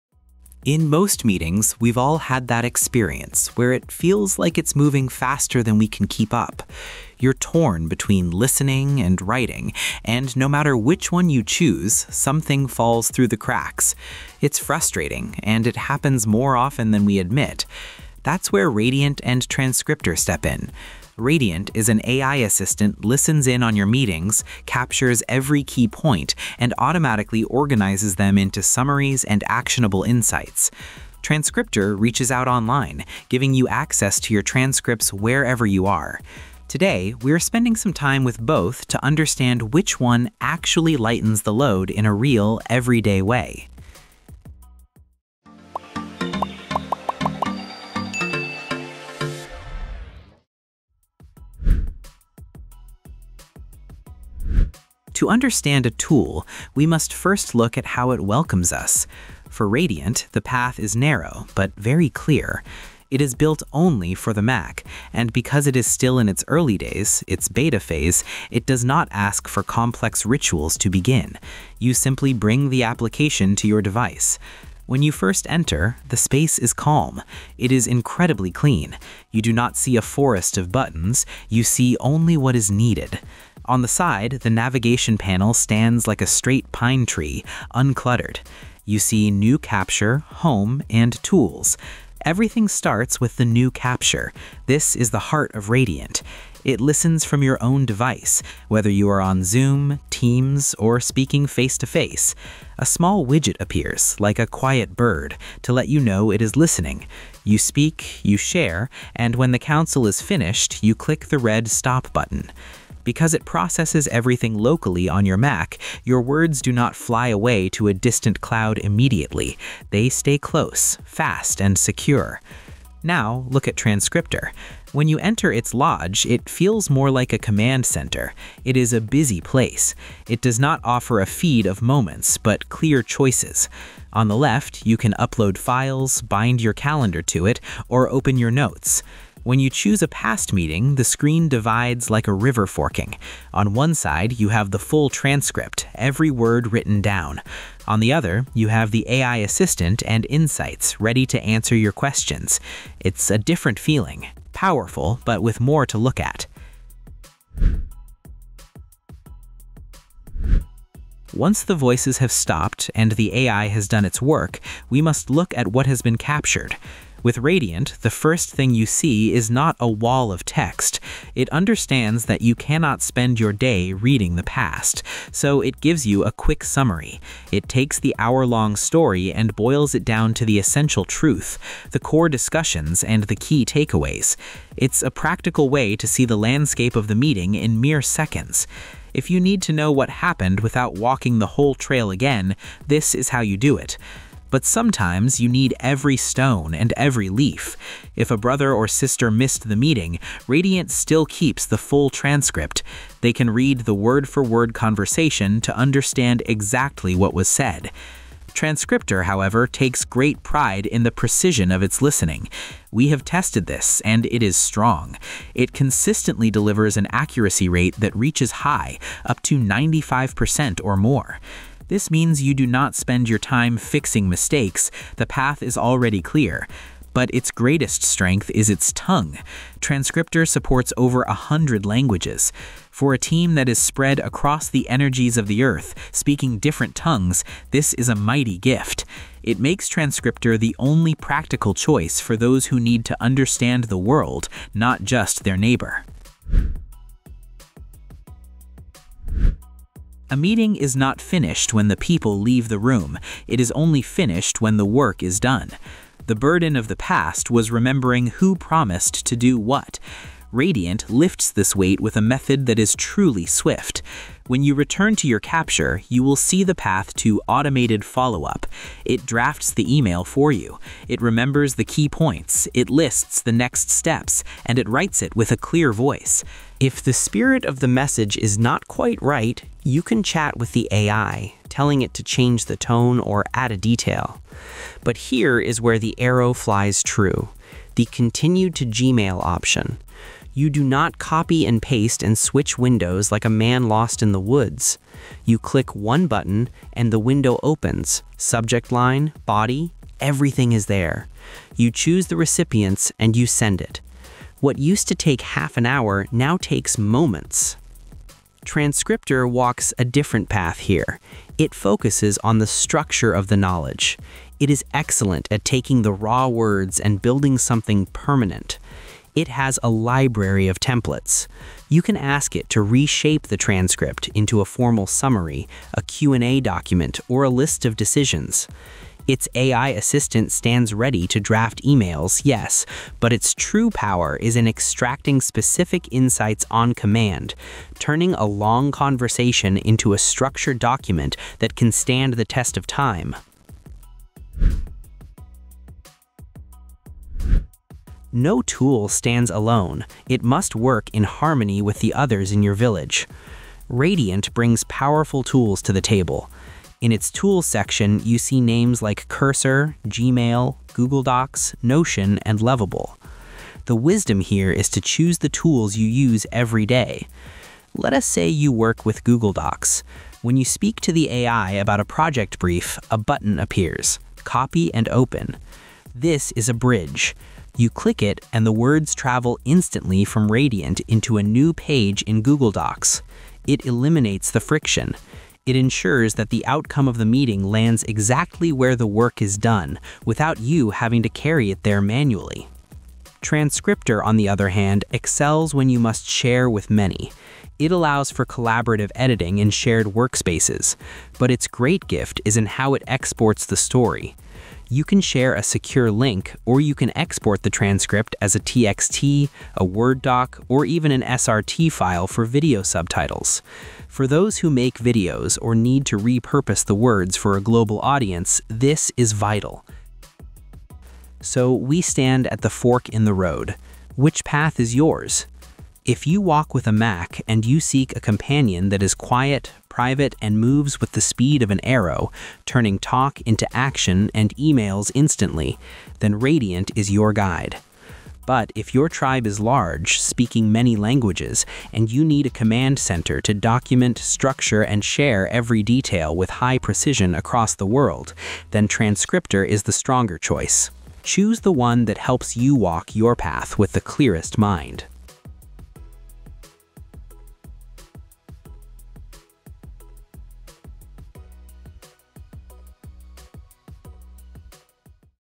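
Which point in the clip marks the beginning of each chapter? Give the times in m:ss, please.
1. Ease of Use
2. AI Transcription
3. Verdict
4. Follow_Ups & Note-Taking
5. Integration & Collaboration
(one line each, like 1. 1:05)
1. 0:52
2. 2:38
3. 7:02
4. 4:07
5. 5:44.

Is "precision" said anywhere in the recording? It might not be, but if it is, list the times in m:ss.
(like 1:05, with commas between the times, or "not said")
3:31, 7:26.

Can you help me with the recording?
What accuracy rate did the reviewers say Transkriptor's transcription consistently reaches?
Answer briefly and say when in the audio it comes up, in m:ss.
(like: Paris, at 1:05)
95%, at 3:39.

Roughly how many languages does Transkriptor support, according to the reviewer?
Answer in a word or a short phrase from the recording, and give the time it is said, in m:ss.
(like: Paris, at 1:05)
Over a hundred, at 3:50.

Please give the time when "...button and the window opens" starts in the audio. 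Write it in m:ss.
4:56.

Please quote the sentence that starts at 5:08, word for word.
Transkriptor walks a different path here.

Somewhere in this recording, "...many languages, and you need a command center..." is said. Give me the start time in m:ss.
7:20.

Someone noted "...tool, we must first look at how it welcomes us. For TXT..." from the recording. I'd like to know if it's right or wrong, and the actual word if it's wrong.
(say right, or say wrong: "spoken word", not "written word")
wrong: "Radiant", not "TXT".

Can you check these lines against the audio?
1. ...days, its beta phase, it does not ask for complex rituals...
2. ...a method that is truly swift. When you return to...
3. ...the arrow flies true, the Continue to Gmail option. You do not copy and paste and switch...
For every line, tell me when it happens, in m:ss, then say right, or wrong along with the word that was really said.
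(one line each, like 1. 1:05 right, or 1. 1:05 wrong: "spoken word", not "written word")
1. 1:06 right
2. 4:22 right
3. 4:45 right.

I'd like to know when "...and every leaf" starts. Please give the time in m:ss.
3:16.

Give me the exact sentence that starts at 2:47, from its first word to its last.
With Radiant, the first thing you see is not a wall of text.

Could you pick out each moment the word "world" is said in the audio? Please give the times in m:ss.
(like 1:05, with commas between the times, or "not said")
4:03, 7:27.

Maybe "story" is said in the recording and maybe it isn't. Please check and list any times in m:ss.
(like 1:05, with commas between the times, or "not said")
2:58, 6:43.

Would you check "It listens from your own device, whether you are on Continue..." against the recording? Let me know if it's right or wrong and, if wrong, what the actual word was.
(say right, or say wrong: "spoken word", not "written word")
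wrong: "Zoom", not "Continue".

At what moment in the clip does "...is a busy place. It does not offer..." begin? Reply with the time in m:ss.
2:08.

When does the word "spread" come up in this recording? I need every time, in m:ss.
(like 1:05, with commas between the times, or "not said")
3:53.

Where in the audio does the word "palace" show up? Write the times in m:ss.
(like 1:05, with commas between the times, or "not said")
not said.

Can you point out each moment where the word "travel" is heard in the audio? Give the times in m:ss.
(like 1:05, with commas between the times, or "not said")
6:19.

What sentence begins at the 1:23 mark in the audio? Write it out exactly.
On the side, the navigation panel stands like a straight pine tree, uncluttered.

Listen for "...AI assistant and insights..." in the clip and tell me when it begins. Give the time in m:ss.
2:29.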